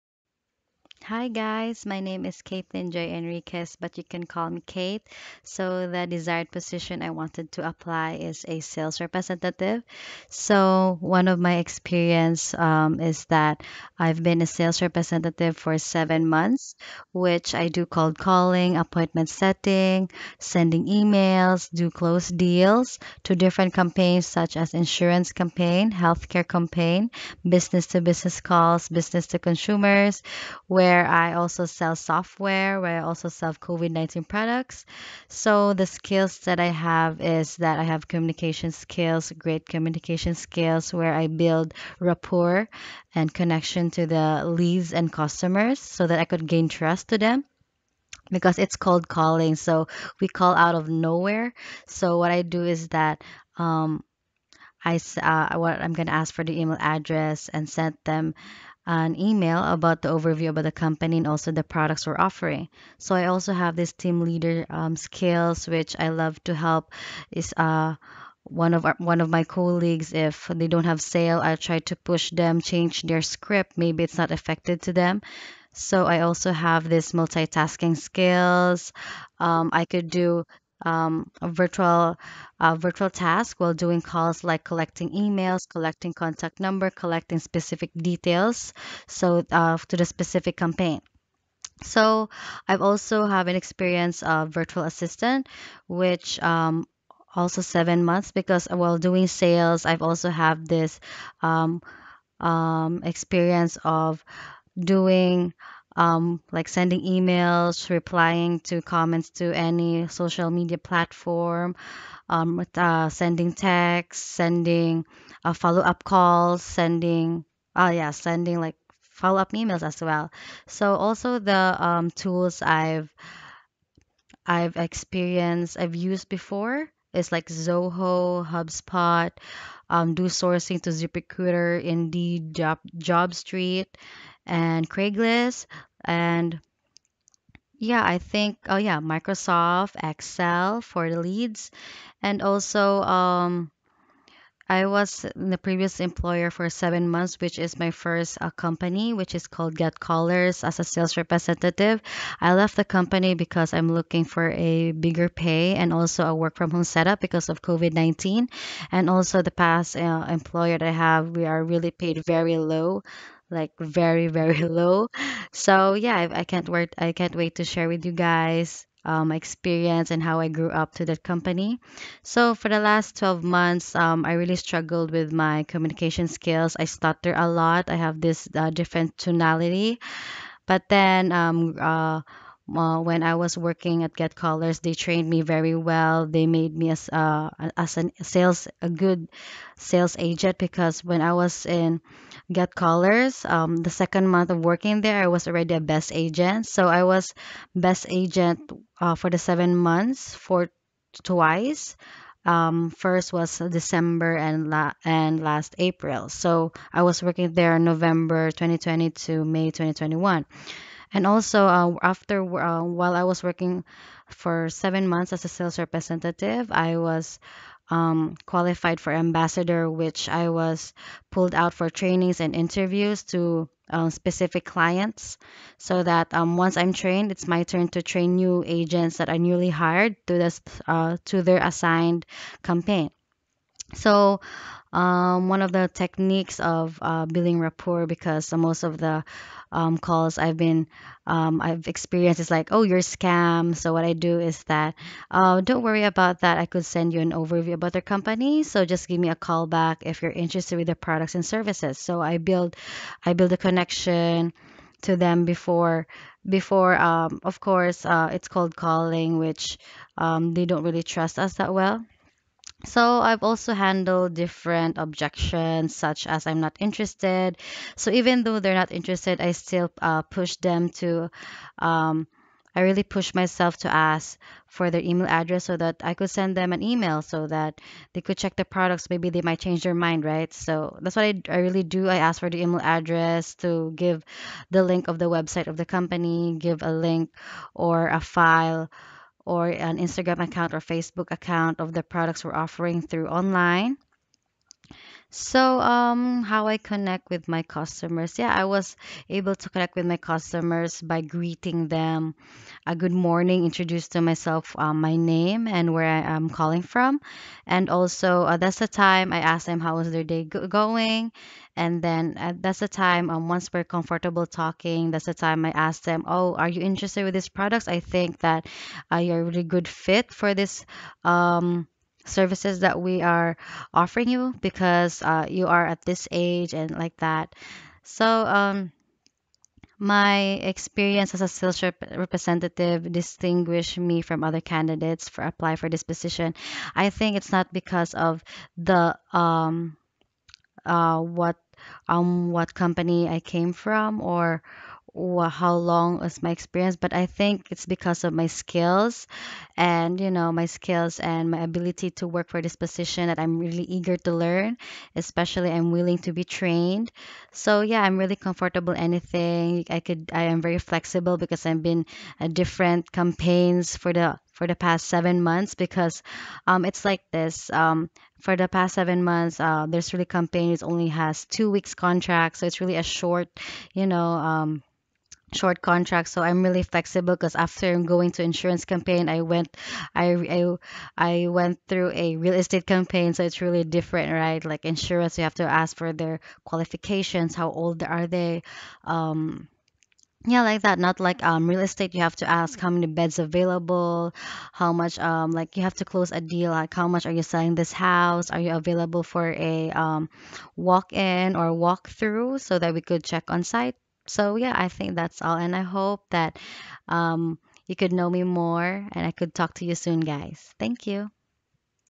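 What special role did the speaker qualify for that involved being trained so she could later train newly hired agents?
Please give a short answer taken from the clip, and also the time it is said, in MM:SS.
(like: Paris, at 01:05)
Ambassador, at 03:39.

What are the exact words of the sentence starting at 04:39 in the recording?
Maybe they might change their mind, right?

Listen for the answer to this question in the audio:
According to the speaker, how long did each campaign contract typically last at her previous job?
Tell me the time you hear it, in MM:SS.
06:11.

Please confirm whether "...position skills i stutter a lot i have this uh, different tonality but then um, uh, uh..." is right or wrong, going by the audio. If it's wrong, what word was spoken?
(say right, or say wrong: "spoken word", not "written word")
wrong: "communication", not "position".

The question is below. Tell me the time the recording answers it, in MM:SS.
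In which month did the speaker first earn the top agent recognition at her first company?
03:23.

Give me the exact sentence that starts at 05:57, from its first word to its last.
So, yeah, I'm really comfortable anything.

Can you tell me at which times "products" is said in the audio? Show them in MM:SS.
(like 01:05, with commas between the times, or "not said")
00:34, 01:01, 04:10, 04:38, 04:52, 05:17.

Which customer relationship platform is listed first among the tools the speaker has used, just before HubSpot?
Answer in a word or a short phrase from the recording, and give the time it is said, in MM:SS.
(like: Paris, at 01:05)
Zoho, at 02:07.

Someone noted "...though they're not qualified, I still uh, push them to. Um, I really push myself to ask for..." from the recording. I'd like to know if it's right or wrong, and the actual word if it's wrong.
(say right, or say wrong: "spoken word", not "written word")
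wrong: "interested", not "qualified".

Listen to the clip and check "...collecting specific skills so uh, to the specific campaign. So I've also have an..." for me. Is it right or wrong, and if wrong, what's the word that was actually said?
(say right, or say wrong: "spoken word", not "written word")
wrong: "details", not "skills".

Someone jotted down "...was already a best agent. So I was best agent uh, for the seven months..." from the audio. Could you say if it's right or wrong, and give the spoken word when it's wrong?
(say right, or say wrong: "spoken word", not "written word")
right.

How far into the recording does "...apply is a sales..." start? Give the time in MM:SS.
00:07.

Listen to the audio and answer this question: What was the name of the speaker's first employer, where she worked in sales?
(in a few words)
Get Callers.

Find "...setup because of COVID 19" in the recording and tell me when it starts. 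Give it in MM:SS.
02:36.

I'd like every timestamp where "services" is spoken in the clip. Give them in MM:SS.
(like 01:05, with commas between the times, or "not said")
04:11, 05:22.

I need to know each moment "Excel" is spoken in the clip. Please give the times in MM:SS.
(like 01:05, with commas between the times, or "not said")
02:20.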